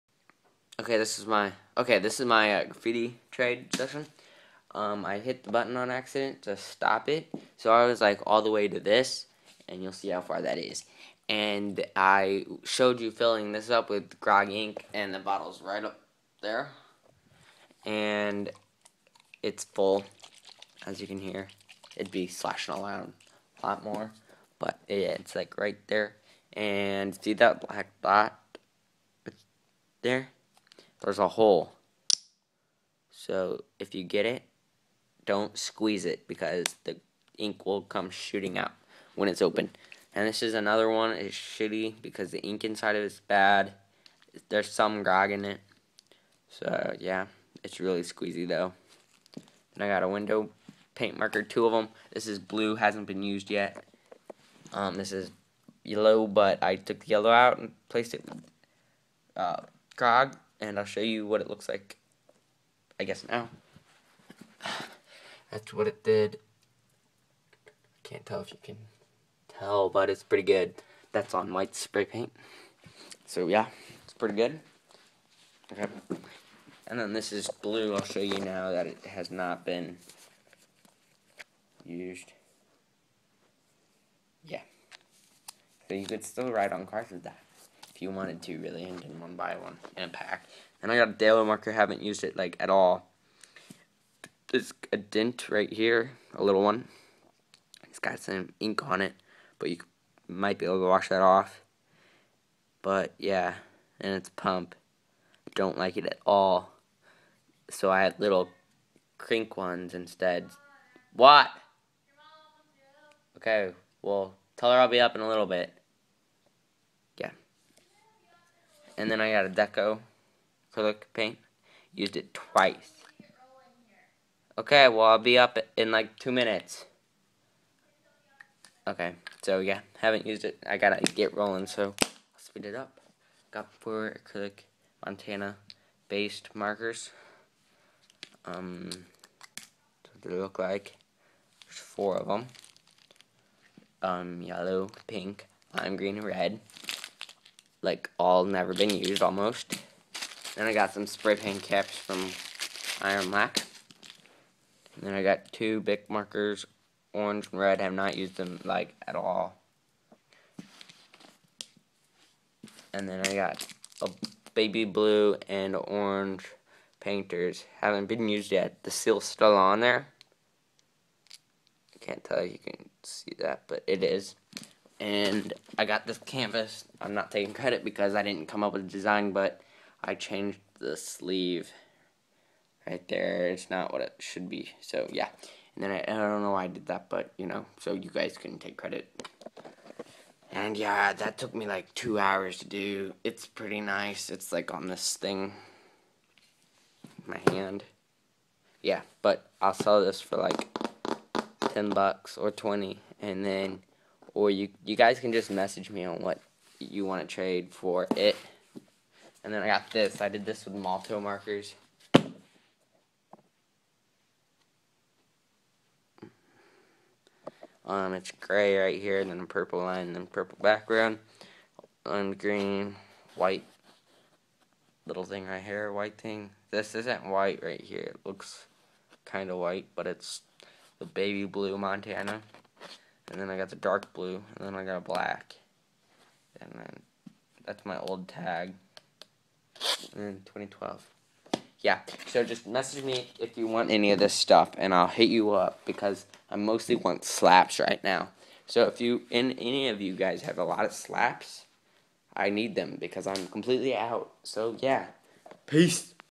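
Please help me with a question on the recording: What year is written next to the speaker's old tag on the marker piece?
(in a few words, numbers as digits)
2012.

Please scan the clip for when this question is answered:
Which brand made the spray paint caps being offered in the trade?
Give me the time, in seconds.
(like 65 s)
153 s.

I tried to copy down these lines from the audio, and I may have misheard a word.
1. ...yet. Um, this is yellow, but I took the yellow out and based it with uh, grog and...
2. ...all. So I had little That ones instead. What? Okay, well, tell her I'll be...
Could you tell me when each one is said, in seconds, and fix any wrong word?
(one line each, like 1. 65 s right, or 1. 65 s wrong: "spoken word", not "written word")
1. 53 s wrong: "placed", not "based"
2. 106 s wrong: "Krink", not "That".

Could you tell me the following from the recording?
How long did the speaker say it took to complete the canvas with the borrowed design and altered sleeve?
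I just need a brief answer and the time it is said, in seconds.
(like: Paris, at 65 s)
2 hours, at 191 s.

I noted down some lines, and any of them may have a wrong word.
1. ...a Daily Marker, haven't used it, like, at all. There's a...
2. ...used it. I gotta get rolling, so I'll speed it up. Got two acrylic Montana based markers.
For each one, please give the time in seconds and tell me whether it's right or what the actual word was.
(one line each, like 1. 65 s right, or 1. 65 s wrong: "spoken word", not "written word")
1. 91 s right
2. 130 s wrong: "four", not "two".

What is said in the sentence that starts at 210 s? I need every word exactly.
I did this with Molotow markers.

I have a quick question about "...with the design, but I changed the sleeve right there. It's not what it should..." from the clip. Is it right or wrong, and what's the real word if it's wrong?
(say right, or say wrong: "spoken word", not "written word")
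right.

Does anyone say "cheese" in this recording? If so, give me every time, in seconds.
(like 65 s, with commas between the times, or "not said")
not said.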